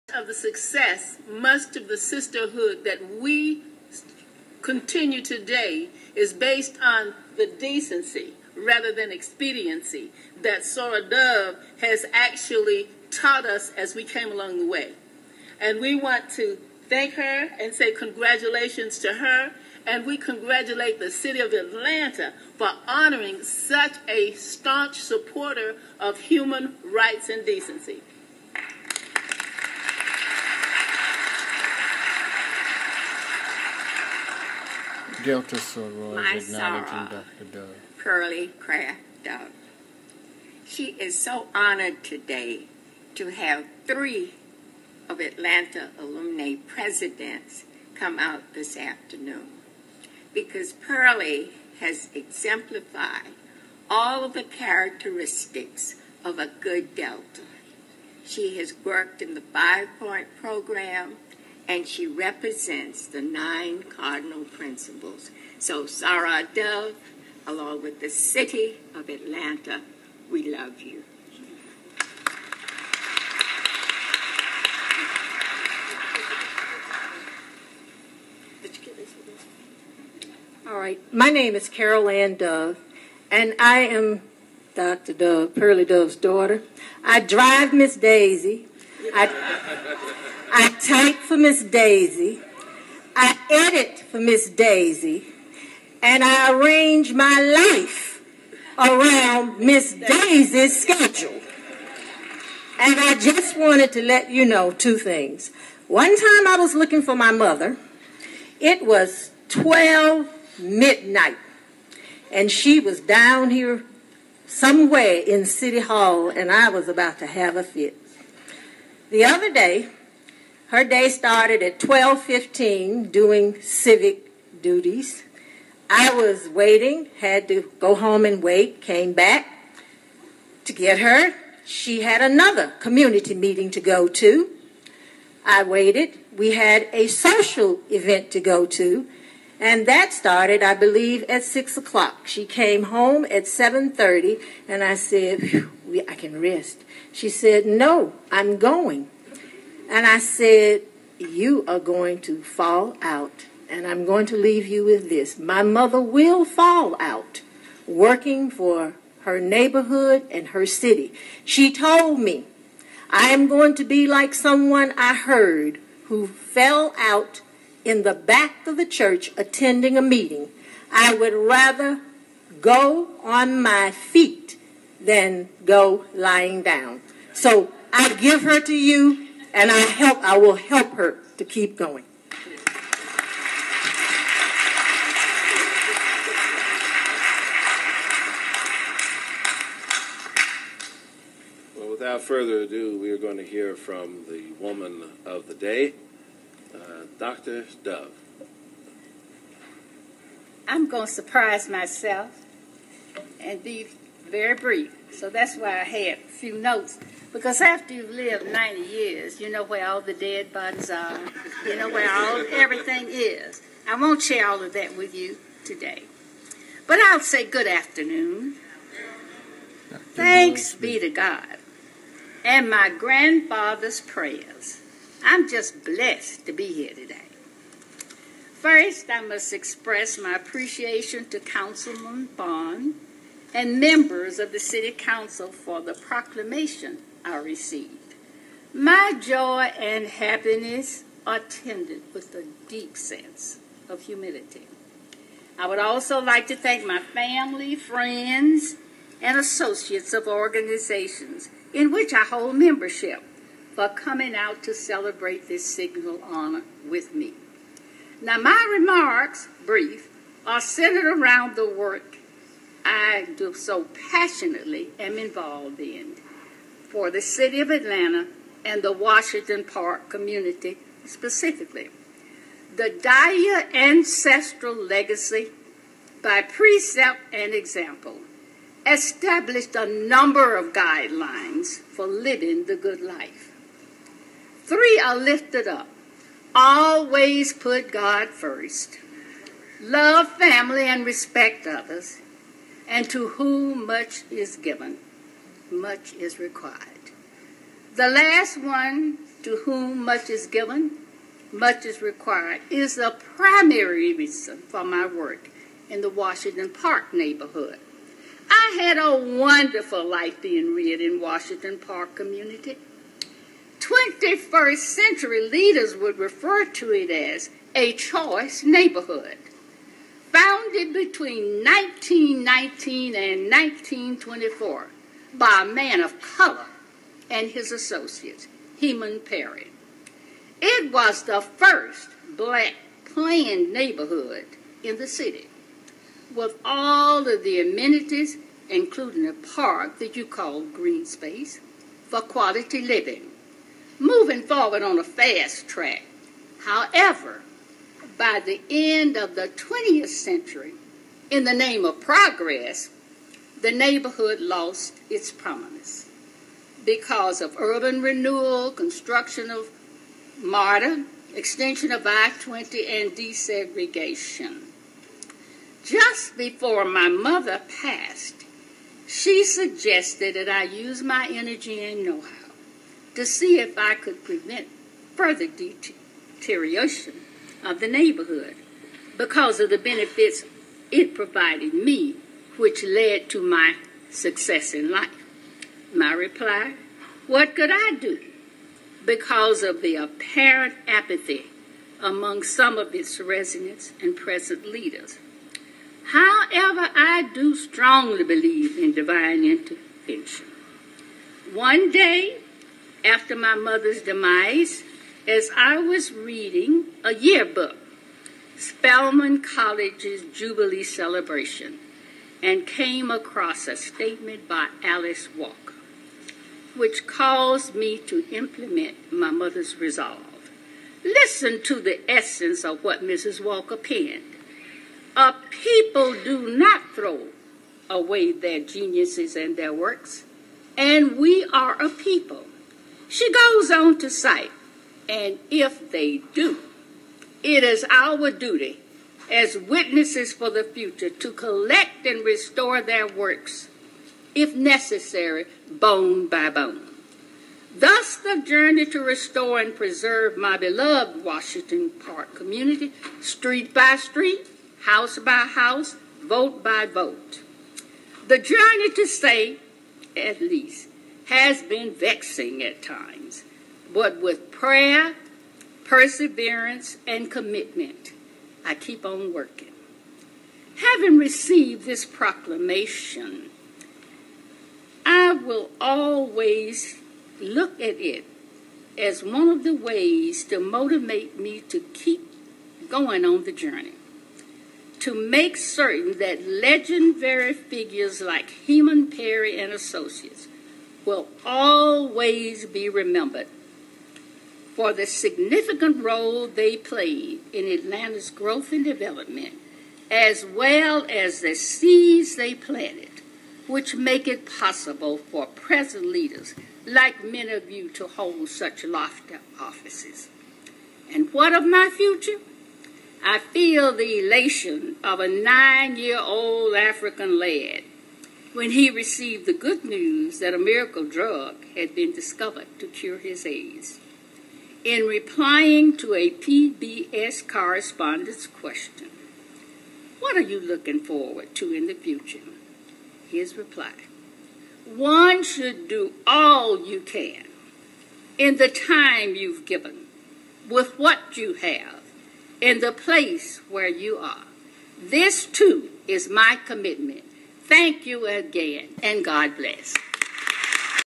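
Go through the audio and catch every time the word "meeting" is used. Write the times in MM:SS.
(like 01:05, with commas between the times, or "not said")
02:13, 02:50.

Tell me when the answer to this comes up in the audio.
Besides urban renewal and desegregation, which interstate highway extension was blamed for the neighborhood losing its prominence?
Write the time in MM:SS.
06:02.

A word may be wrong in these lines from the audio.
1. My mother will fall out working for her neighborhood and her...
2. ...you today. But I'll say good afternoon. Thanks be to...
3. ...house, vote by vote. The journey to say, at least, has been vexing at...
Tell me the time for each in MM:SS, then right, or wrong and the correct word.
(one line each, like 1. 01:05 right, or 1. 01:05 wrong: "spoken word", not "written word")
1. 02:35 right
2. 03:35 right
3. 07:35 right.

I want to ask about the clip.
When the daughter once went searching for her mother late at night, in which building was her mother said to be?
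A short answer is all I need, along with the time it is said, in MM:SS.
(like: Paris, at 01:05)
City Hall, at 01:55.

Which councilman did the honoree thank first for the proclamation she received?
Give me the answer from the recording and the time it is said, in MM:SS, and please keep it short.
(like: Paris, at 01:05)
Councilman Bond, at 03:51.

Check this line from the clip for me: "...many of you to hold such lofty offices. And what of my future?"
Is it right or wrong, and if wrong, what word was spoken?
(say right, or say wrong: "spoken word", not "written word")
right.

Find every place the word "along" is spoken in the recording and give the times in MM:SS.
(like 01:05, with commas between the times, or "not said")
00:14, 01:07.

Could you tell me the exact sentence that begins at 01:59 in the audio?
The other day, her day started at 12:15 doing civic duties.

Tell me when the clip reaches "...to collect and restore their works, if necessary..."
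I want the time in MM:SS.
07:21.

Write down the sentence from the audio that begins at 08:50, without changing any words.
What are you looking forward to in the future?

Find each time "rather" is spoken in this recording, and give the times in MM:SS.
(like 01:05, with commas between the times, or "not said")
00:08, 02:51.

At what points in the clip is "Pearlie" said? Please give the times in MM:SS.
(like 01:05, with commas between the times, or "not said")
00:37, 00:50, 01:25.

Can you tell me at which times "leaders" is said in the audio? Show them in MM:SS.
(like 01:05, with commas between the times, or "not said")
05:15, 06:34, 08:26.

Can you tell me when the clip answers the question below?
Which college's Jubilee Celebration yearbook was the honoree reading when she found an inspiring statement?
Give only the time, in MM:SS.
06:48.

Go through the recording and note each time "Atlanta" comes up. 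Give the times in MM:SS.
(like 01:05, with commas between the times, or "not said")
00:21, 00:45, 01:09, 04:27, 08:17.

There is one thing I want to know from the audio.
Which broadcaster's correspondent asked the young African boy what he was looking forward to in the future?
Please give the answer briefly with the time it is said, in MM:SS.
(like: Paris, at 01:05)
PBS, at 08:46.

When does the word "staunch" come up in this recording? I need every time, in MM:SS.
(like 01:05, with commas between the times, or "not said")
00:24.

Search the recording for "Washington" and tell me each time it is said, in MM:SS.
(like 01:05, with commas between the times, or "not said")
04:28, 05:06, 05:11, 07:31.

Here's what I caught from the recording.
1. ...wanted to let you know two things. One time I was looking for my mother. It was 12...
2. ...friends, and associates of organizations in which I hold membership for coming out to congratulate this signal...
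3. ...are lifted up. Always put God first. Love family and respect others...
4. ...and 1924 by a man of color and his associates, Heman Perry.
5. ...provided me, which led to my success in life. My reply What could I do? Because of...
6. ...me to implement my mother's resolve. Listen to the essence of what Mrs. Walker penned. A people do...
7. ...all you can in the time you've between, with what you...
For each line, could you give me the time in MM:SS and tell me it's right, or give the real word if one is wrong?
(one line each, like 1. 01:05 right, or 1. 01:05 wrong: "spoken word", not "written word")
1. 01:43 right
2. 04:07 wrong: "celebrate", not "congratulate"
3. 04:45 right
4. 05:23 right
5. 06:21 right
6. 06:57 right
7. 08:56 wrong: "given", not "between".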